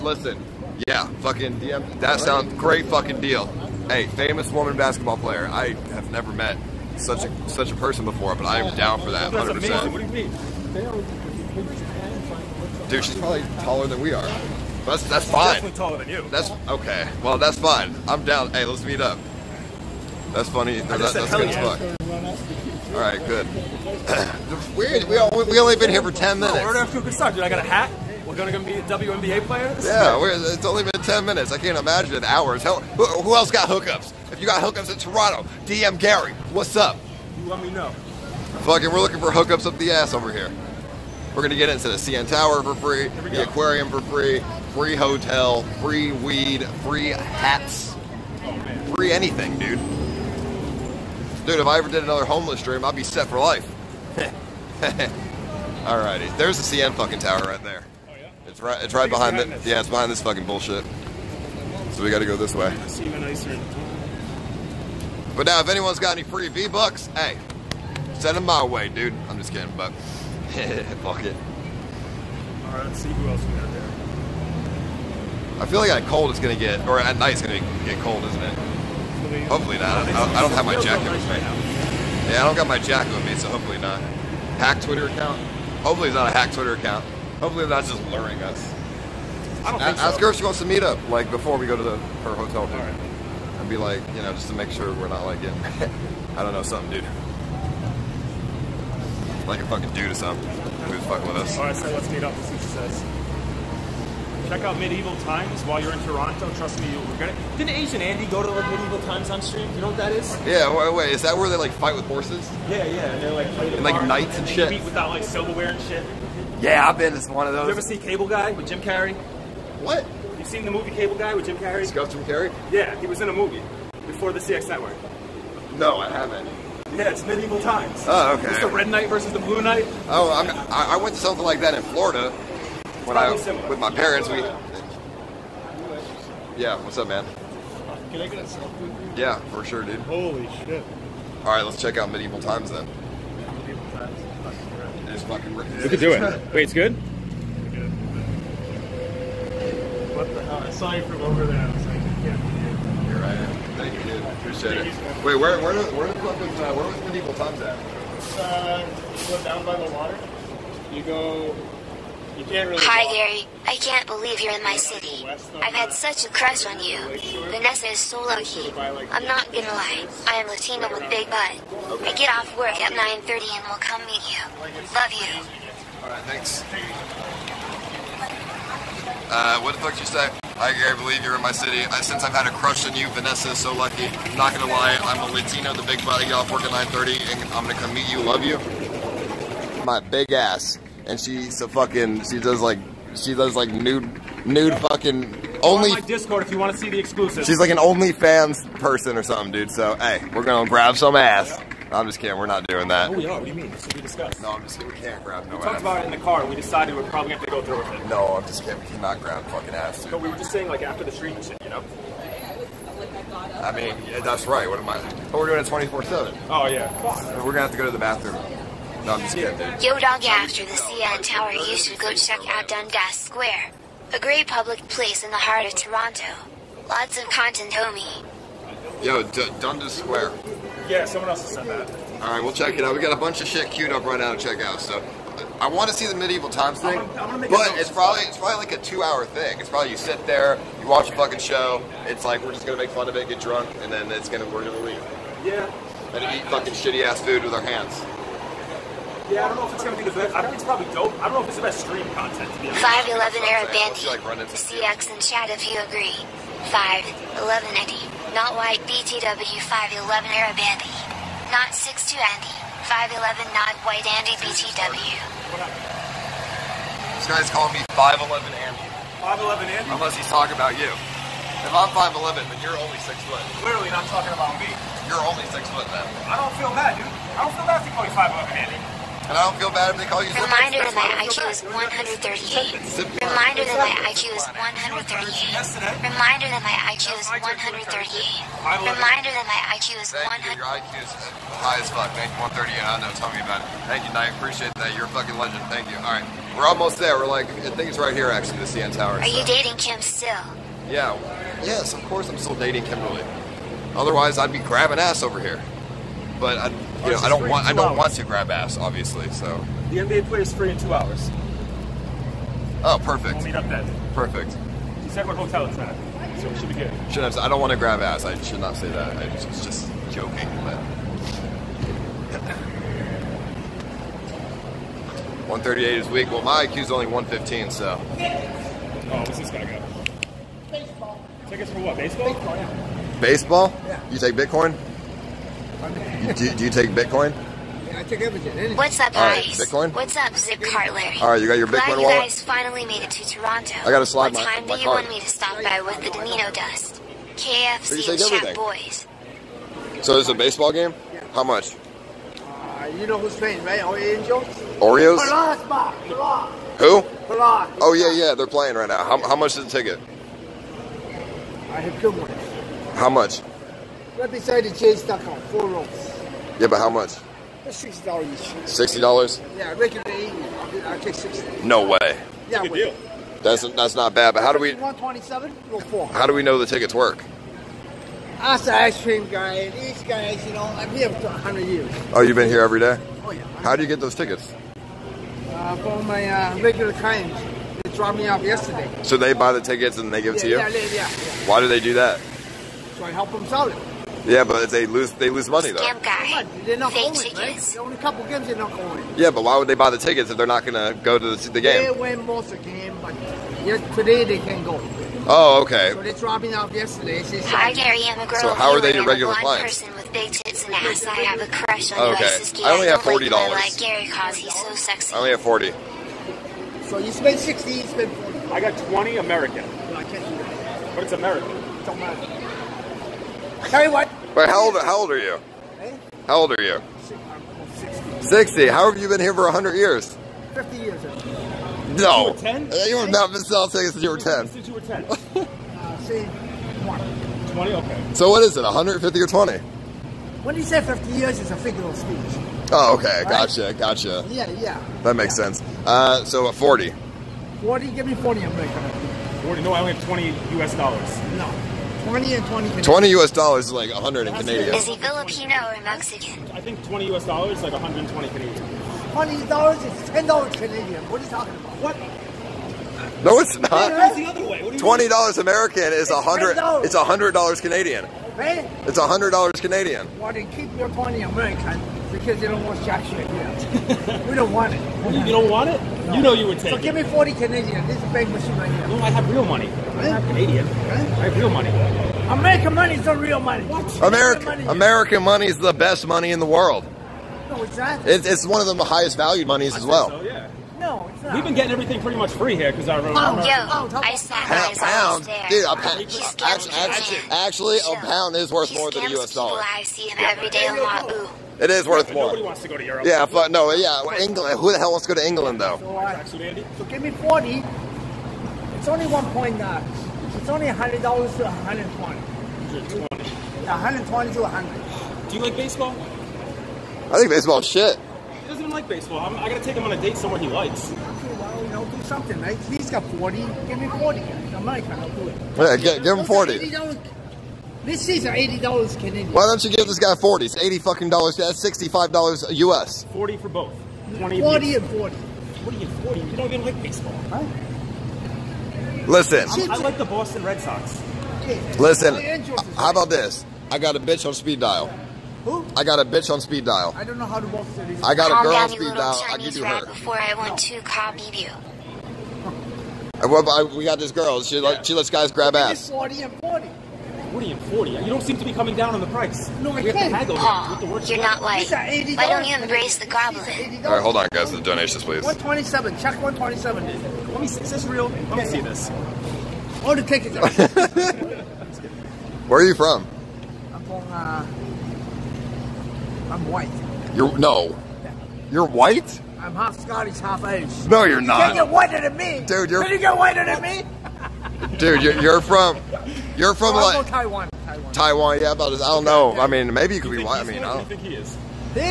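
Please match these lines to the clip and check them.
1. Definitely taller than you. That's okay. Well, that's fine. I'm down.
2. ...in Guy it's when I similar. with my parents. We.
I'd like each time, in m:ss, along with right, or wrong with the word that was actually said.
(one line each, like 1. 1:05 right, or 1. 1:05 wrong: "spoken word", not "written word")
1. 0:15 right
2. 2:11 wrong: "Florida", not "Guy".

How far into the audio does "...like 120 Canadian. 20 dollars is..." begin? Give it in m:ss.
7:37.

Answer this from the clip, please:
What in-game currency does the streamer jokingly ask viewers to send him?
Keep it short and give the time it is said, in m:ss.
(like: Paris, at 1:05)
V bucks, at 1:06.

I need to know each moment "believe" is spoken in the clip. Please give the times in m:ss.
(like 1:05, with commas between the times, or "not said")
2:44, 3:00.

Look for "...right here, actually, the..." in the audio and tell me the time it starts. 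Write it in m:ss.
4:58.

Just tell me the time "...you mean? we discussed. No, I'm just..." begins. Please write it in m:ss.
3:23.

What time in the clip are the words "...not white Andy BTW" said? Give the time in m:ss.
4:23.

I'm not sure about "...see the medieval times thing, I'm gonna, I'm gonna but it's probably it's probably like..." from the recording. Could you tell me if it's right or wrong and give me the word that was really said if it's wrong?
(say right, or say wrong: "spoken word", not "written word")
right.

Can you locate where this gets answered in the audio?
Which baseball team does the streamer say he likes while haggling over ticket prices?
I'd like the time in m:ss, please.
9:00.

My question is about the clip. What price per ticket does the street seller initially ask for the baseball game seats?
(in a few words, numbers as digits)
60 dollars.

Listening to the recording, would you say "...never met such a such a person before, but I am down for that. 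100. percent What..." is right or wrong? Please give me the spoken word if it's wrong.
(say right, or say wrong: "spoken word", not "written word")
right.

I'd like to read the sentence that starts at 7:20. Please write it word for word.
When you say 50 years, it's a figure of speech.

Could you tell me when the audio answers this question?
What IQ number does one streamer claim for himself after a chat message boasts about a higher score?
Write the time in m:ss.
5:27.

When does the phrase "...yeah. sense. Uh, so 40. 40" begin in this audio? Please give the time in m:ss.
7:25.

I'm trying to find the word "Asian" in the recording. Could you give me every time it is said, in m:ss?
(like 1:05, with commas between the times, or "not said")
1:47.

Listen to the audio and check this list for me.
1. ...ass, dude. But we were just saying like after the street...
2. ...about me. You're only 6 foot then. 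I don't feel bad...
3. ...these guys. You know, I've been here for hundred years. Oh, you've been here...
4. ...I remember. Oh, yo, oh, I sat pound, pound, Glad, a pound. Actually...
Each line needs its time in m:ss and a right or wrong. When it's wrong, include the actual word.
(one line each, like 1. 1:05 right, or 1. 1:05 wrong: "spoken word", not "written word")
1. 3:29 right
2. 4:34 right
3. 6:19 right
4. 8:12 wrong: "Dude", not "Glad".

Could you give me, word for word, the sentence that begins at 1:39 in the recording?
Like a fucking dude or something who's fucking with us.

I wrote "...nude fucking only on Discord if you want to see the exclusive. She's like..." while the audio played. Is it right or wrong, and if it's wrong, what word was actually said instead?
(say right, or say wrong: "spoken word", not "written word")
right.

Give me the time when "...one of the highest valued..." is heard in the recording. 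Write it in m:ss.
8:08.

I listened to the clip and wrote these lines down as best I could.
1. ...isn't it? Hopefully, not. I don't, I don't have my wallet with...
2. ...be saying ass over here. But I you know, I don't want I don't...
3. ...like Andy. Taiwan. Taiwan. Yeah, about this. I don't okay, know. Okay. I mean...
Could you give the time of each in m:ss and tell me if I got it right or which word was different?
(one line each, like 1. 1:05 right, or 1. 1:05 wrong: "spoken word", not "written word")
1. 1:18 wrong: "jacket", not "wallet"
2. 5:04 wrong: "grabbing", not "saying"
3. 9:46 wrong: "Taiwan", not "Andy".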